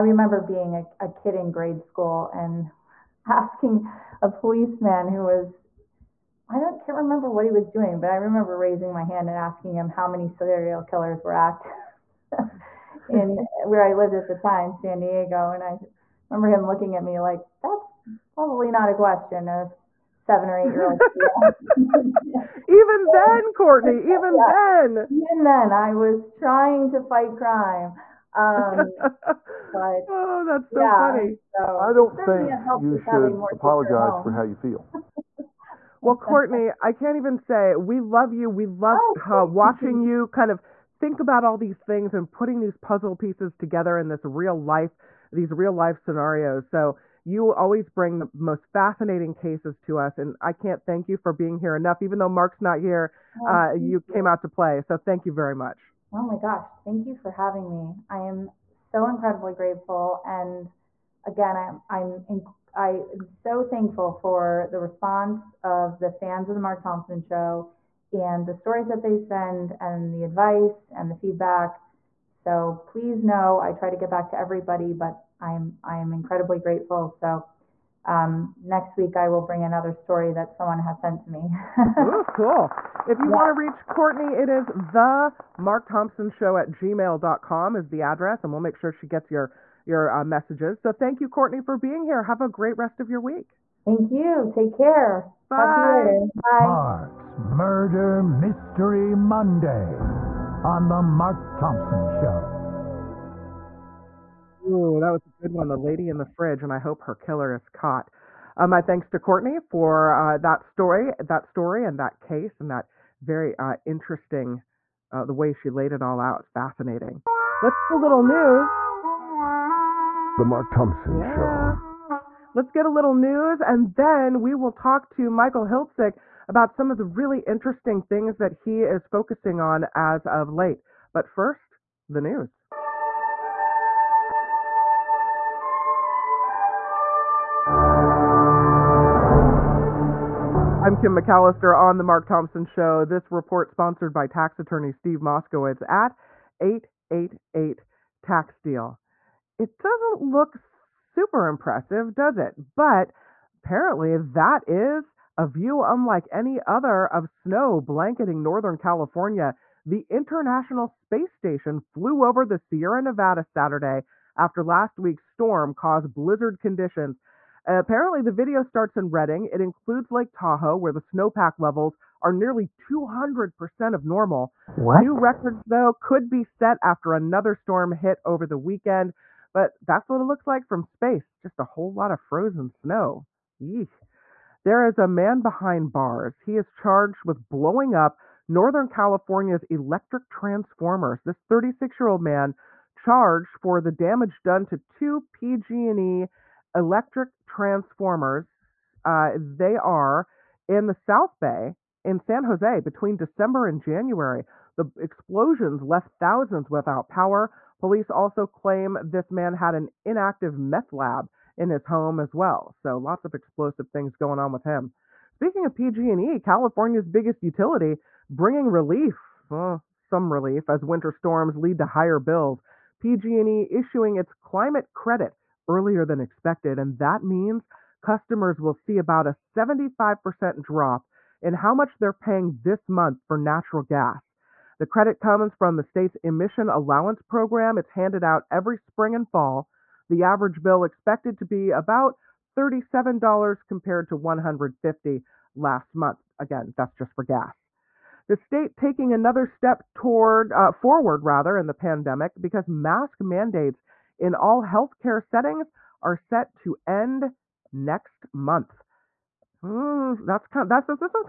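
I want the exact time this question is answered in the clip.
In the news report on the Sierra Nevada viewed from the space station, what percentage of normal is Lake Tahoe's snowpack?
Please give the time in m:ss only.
2:52.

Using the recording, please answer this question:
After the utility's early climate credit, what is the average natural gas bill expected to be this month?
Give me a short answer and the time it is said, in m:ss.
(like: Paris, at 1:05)
$37, at 4:02.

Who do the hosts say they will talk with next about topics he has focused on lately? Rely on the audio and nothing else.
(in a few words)
Michael Hiltzik.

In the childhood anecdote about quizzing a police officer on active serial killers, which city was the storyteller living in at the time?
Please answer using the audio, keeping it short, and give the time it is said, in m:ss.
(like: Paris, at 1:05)
San Diego, at 0:14.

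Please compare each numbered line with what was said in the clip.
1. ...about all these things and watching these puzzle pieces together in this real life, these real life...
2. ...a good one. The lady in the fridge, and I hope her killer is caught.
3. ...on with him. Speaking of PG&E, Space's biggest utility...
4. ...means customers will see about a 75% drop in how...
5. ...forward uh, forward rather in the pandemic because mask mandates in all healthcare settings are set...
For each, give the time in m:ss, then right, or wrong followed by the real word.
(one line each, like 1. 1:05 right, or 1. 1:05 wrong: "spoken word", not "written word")
1. 0:41 wrong: "putting", not "watching"
2. 1:45 right
3. 3:34 wrong: "California", not "Space"
4. 3:47 right
5. 4:09 wrong: "toward", not "forward".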